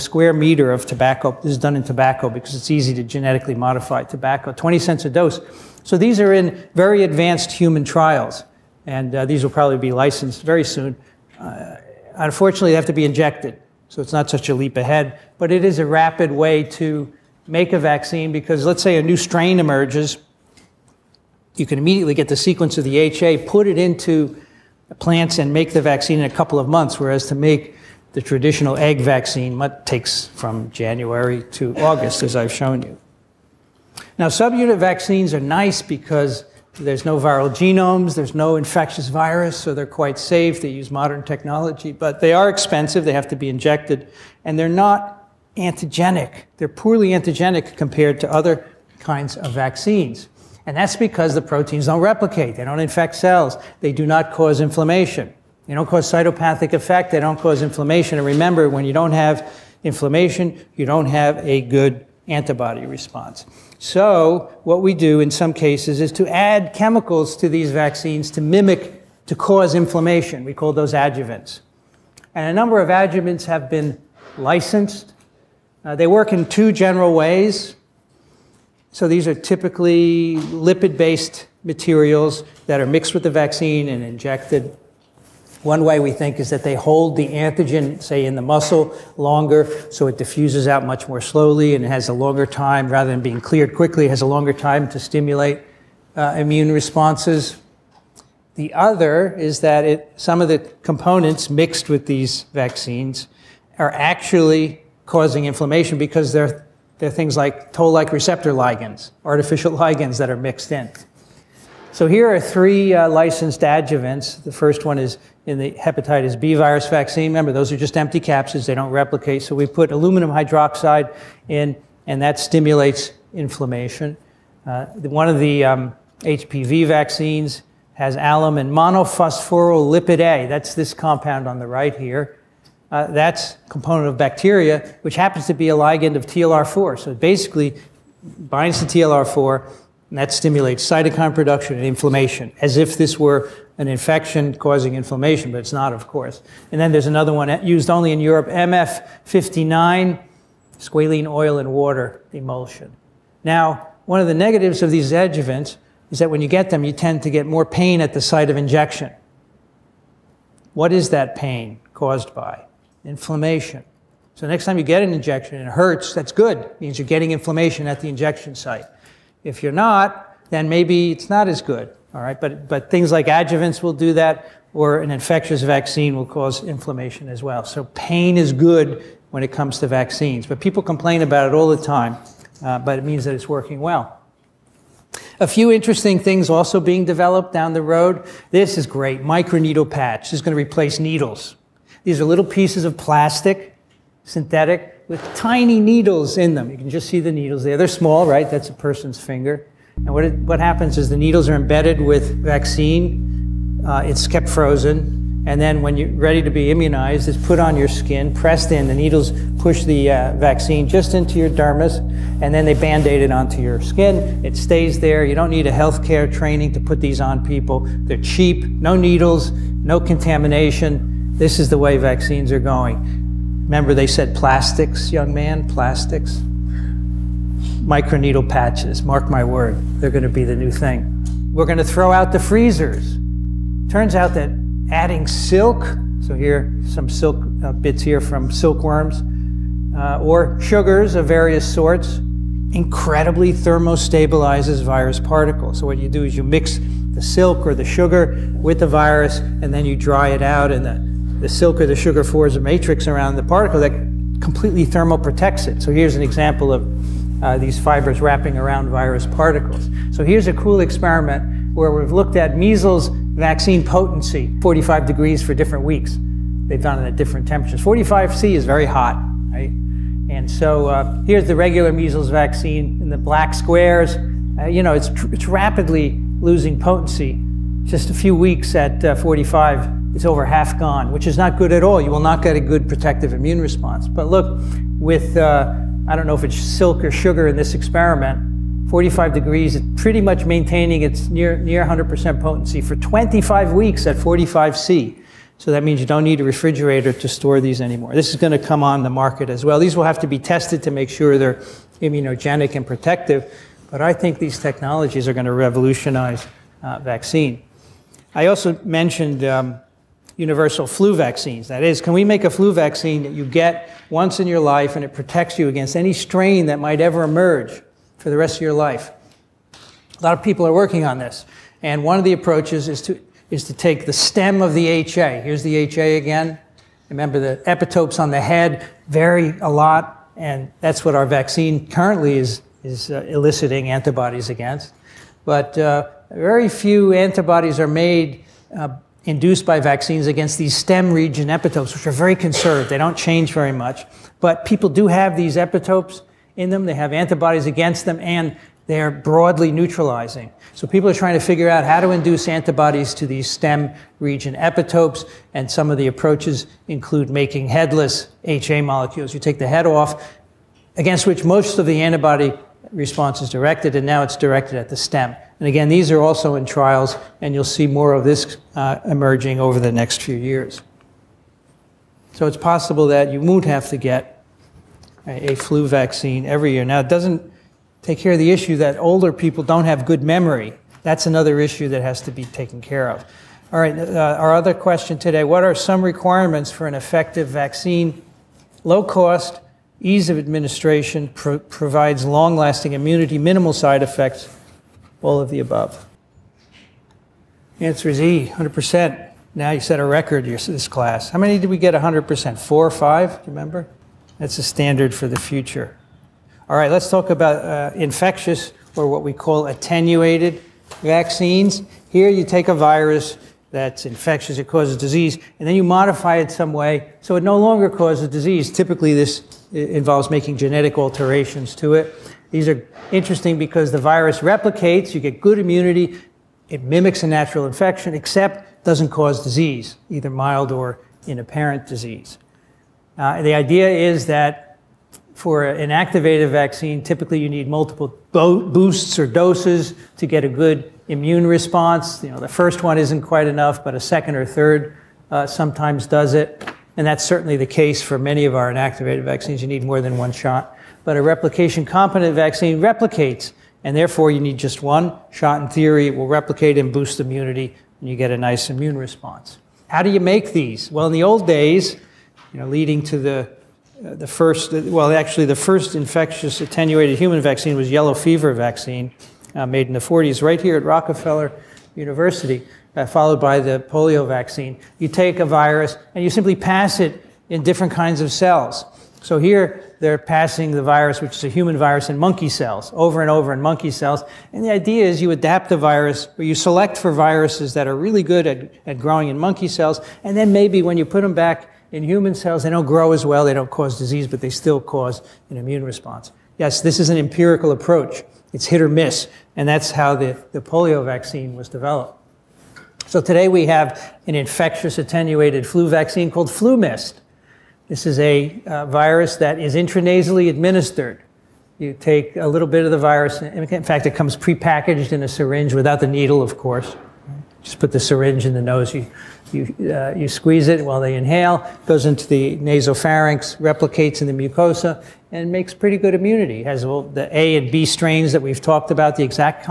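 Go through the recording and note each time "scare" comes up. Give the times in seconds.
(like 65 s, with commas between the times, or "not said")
not said.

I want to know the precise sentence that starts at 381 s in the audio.
That's another issue that has to be taken care of.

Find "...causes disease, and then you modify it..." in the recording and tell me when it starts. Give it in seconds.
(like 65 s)
414 s.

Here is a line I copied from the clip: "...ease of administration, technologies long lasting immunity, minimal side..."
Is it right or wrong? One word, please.
wrong.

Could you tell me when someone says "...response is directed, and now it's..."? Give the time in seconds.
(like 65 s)
362 s.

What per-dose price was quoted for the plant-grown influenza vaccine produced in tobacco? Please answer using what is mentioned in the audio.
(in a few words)
20 cents.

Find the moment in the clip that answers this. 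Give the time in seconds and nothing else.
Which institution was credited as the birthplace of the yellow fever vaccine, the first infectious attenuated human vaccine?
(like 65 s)
470 s.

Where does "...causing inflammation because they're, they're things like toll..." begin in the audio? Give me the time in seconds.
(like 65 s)
105 s.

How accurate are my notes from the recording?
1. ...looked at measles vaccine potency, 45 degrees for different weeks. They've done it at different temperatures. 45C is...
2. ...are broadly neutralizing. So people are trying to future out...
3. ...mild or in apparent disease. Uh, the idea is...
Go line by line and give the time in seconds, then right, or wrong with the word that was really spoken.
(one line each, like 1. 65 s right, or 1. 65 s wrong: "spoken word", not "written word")
1. 262 s right
2. 349 s wrong: "figure", not "future"
3. 430 s right.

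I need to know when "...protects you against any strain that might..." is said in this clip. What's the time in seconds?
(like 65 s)
315 s.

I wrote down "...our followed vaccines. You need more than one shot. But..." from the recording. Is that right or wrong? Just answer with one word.
wrong.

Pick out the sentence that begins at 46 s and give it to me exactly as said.
They're poorly antigenic compared to other kinds of vaccines.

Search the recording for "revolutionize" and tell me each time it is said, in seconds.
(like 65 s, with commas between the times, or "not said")
305 s.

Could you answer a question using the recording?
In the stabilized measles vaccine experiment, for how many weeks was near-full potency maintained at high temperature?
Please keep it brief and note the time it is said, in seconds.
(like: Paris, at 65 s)
25 weeks, at 292 s.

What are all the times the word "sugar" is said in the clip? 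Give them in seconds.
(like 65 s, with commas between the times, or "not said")
240 s, 247 s, 251 s, 287 s.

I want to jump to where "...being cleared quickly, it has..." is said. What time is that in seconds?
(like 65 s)
93 s.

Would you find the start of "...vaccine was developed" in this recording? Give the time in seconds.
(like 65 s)
501 s.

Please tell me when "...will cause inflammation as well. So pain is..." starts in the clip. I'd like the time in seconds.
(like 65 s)
176 s.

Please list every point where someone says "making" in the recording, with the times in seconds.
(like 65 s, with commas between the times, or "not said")
357 s, 420 s.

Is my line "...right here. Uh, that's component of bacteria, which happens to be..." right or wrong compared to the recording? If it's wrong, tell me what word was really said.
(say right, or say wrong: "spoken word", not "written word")
right.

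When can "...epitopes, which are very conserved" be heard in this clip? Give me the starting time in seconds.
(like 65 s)
341 s.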